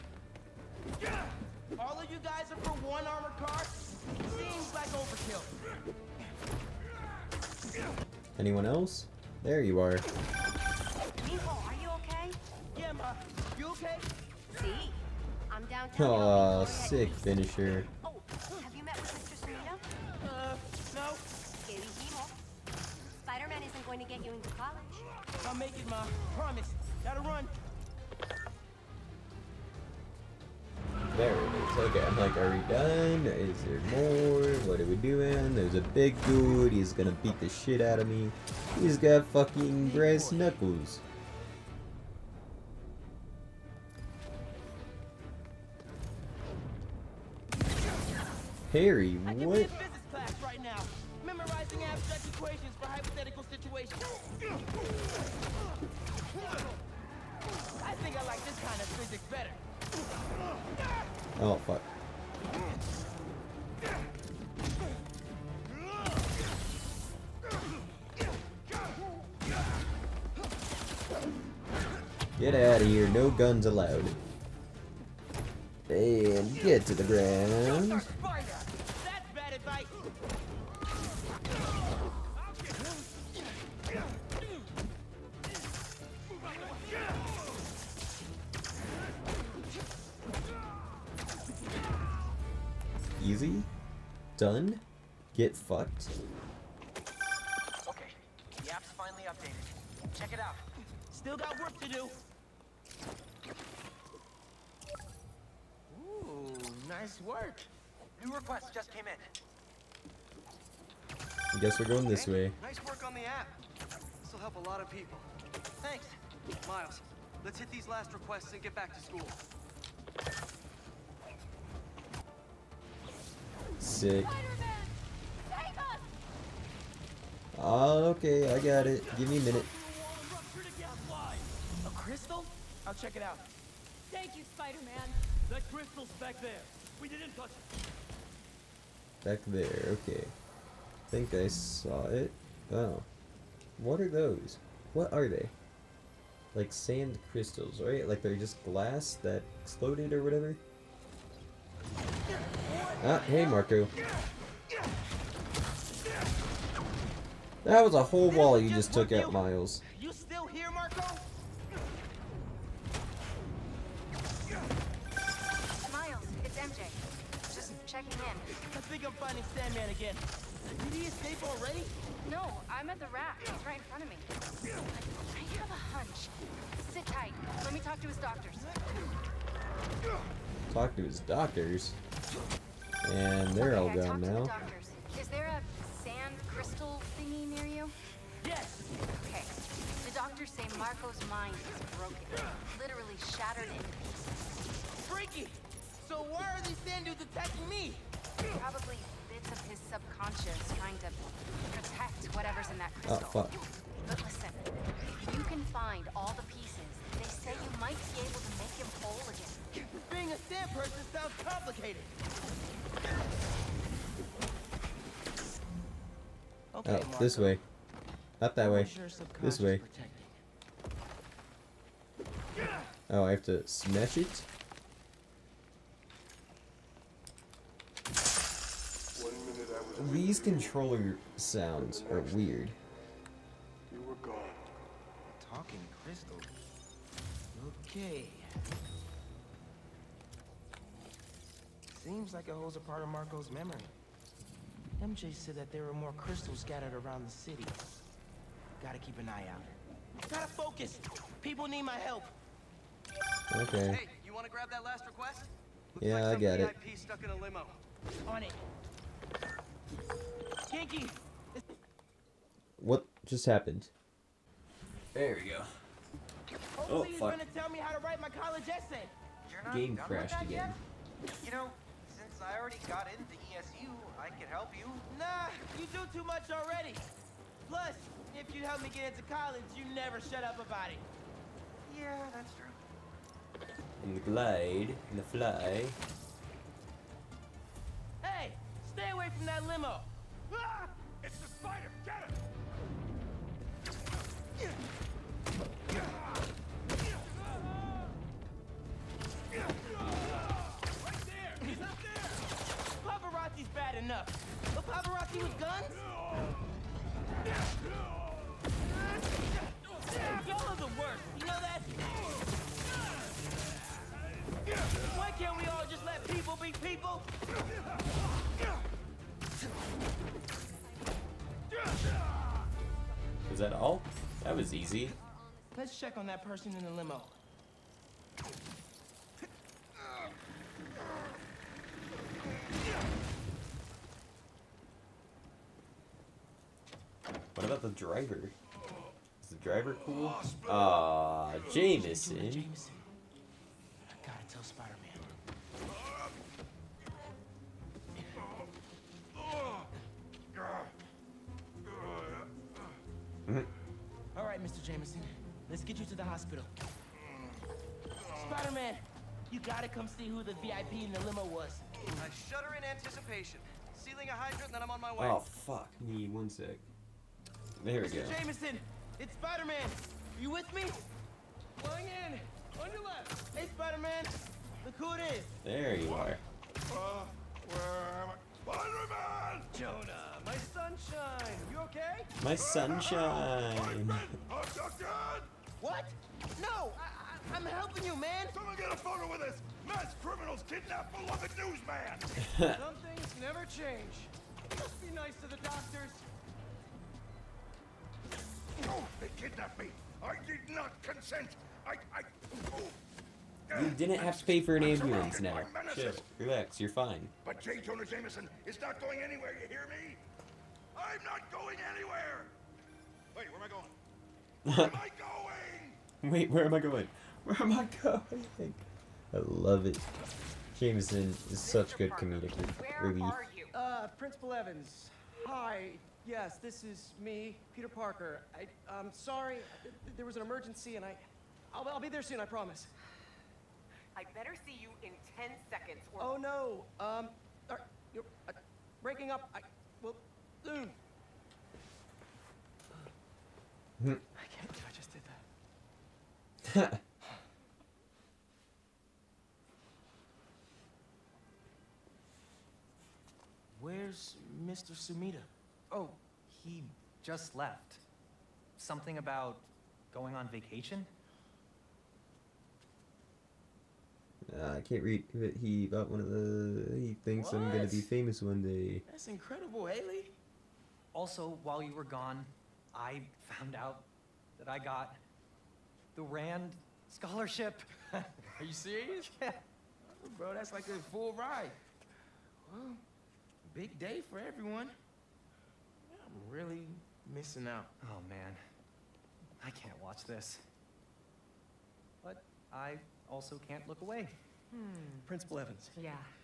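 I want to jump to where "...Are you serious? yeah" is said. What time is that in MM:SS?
07:58.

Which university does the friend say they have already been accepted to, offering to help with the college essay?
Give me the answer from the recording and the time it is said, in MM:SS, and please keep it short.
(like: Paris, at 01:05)
ESU, at 04:33.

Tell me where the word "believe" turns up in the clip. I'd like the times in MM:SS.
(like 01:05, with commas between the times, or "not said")
07:24.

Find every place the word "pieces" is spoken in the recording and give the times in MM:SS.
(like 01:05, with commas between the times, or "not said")
03:14, 03:26.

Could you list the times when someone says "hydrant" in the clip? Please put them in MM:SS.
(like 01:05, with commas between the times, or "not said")
06:04.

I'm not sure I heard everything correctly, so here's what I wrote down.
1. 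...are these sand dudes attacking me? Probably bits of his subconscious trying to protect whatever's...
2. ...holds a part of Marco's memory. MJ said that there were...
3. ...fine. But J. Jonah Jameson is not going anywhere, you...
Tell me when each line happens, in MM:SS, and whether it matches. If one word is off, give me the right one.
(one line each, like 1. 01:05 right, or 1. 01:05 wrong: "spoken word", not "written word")
1. 03:16 right
2. 04:02 right
3. 06:46 right.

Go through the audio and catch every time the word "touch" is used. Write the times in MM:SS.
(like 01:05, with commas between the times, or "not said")
02:17.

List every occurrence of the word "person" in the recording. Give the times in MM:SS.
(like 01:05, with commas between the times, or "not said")
03:30, 05:26.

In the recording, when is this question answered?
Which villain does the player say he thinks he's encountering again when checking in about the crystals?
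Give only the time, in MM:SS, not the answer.
02:49.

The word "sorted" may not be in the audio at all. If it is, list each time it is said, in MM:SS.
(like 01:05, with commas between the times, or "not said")
not said.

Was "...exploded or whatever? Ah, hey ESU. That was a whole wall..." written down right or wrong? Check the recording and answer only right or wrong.
wrong.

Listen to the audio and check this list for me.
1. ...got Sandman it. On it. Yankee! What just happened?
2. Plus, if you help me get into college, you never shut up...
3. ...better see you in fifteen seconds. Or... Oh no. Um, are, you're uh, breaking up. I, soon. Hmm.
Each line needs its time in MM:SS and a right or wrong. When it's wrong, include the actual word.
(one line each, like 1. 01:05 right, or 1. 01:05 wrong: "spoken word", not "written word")
1. 04:16 wrong: "VIP", not "Sandman"
2. 04:37 right
3. 07:14 wrong: "ten", not "fifteen".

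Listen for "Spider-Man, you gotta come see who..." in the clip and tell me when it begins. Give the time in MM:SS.
05:58.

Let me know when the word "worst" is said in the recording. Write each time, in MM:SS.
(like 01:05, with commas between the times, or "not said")
05:10.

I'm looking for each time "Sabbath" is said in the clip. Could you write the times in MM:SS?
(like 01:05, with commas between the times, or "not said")
not said.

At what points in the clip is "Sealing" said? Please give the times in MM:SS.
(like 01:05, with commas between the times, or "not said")
06:03.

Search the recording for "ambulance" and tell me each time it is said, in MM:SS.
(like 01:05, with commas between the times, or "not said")
06:44.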